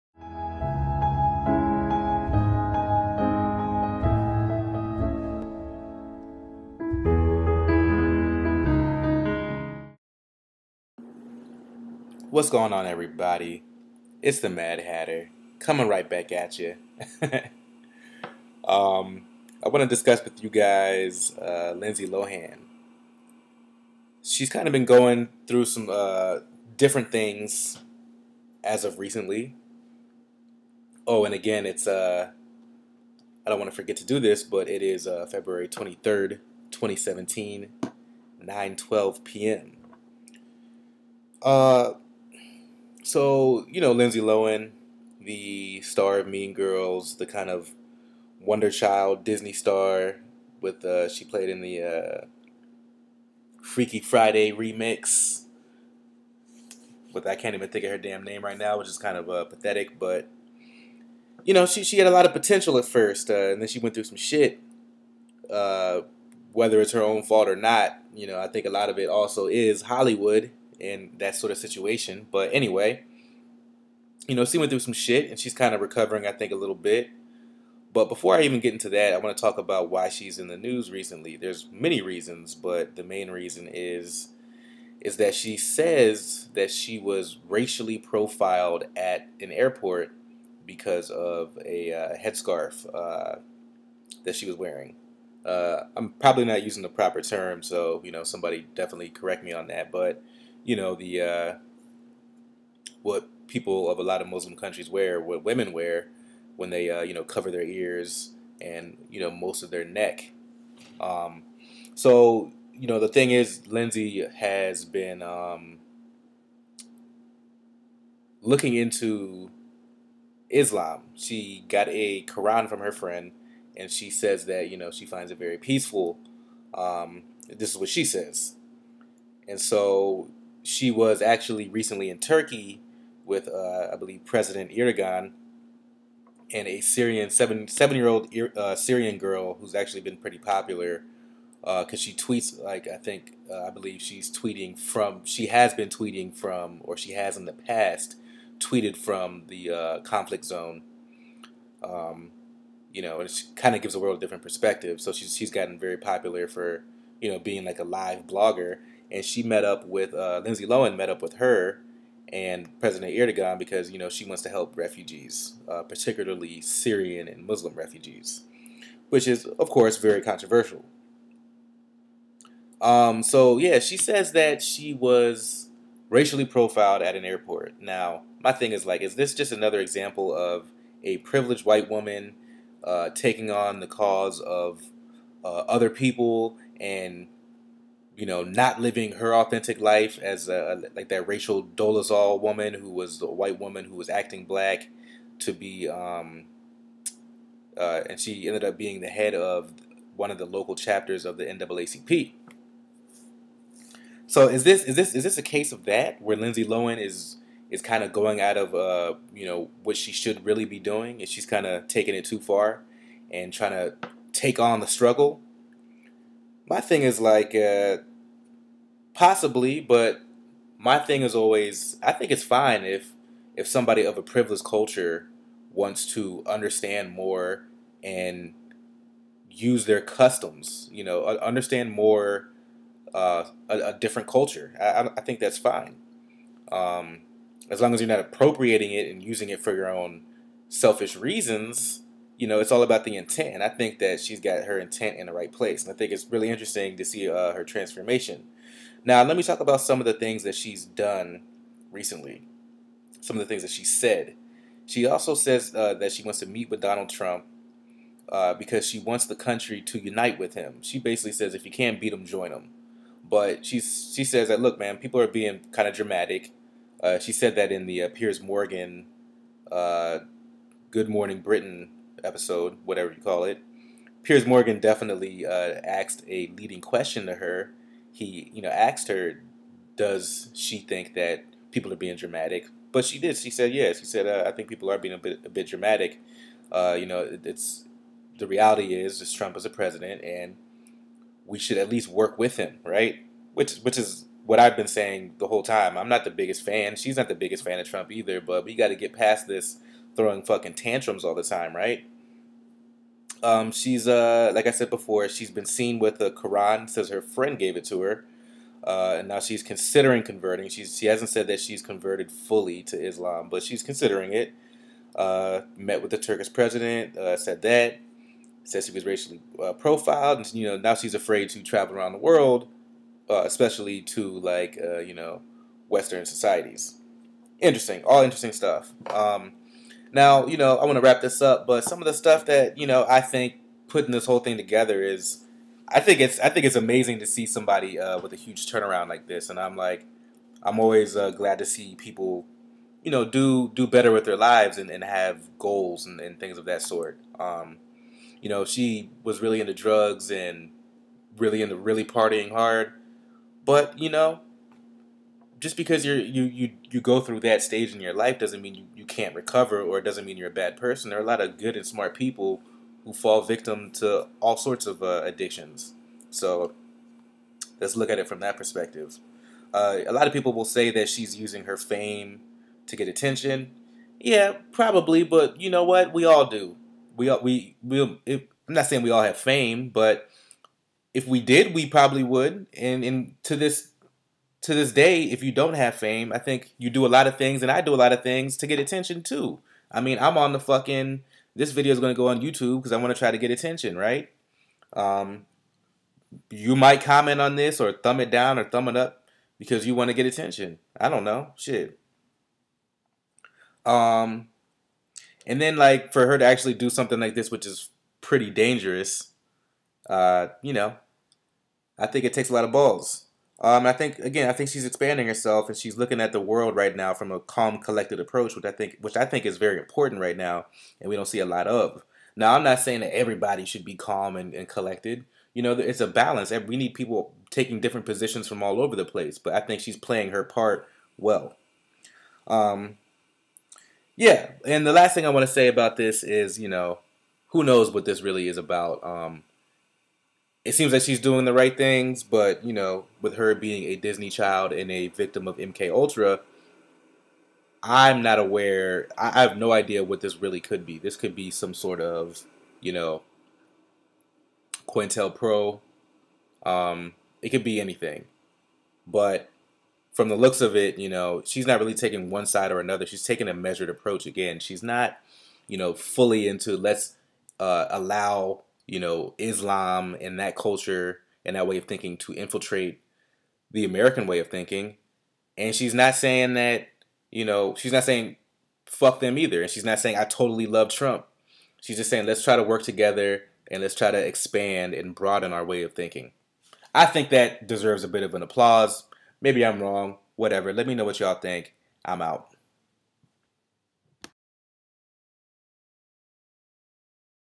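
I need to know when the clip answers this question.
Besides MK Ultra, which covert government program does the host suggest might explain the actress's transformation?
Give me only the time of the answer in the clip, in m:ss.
7:34.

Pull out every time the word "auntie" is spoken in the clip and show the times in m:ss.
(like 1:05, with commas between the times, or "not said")
not said.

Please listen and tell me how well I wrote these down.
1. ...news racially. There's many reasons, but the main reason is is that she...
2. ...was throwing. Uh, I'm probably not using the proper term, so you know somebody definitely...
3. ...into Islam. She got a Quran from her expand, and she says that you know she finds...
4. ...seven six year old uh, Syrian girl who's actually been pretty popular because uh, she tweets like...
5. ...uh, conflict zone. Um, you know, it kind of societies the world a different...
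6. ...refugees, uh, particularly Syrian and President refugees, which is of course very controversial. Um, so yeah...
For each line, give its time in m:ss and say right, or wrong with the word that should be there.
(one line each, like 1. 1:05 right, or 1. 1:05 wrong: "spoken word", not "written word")
1. 1:20 wrong: "recently", not "racially"
2. 1:34 wrong: "wearing", not "throwing"
3. 1:58 wrong: "friend", not "expand"
4. 2:17 wrong: "seven", not "six"
5. 2:29 wrong: "gives", not "societies"
6. 2:44 wrong: "Muslim", not "President".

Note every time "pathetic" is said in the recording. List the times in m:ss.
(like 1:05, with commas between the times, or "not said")
0:59.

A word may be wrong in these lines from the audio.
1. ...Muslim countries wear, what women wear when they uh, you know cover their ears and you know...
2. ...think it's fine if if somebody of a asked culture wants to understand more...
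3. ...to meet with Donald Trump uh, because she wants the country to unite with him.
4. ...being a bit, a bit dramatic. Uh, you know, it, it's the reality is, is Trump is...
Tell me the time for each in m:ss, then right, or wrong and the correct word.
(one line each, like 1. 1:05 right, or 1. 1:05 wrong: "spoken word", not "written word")
1. 1:44 right
2. 3:42 wrong: "privileged", not "asked"
3. 4:16 right
4. 4:44 right.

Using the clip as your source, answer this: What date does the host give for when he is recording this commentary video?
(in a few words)
February 23rd, 2017.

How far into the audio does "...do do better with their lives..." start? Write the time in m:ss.
5:43.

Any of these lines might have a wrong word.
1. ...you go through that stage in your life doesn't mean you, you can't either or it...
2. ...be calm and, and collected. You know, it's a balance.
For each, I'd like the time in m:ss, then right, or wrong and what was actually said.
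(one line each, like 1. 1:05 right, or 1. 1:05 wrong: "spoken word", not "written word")
1. 5:56 wrong: "recover", not "either"
2. 7:03 right.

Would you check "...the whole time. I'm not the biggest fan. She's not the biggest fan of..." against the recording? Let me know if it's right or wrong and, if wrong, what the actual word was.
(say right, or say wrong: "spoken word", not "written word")
right.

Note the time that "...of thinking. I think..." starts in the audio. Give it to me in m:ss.
8:05.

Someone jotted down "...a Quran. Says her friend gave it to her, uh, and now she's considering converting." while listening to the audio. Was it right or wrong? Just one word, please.
right.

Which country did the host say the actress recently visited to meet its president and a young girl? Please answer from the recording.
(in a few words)
Turkey.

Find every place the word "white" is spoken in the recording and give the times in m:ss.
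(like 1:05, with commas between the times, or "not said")
3:01, 3:13.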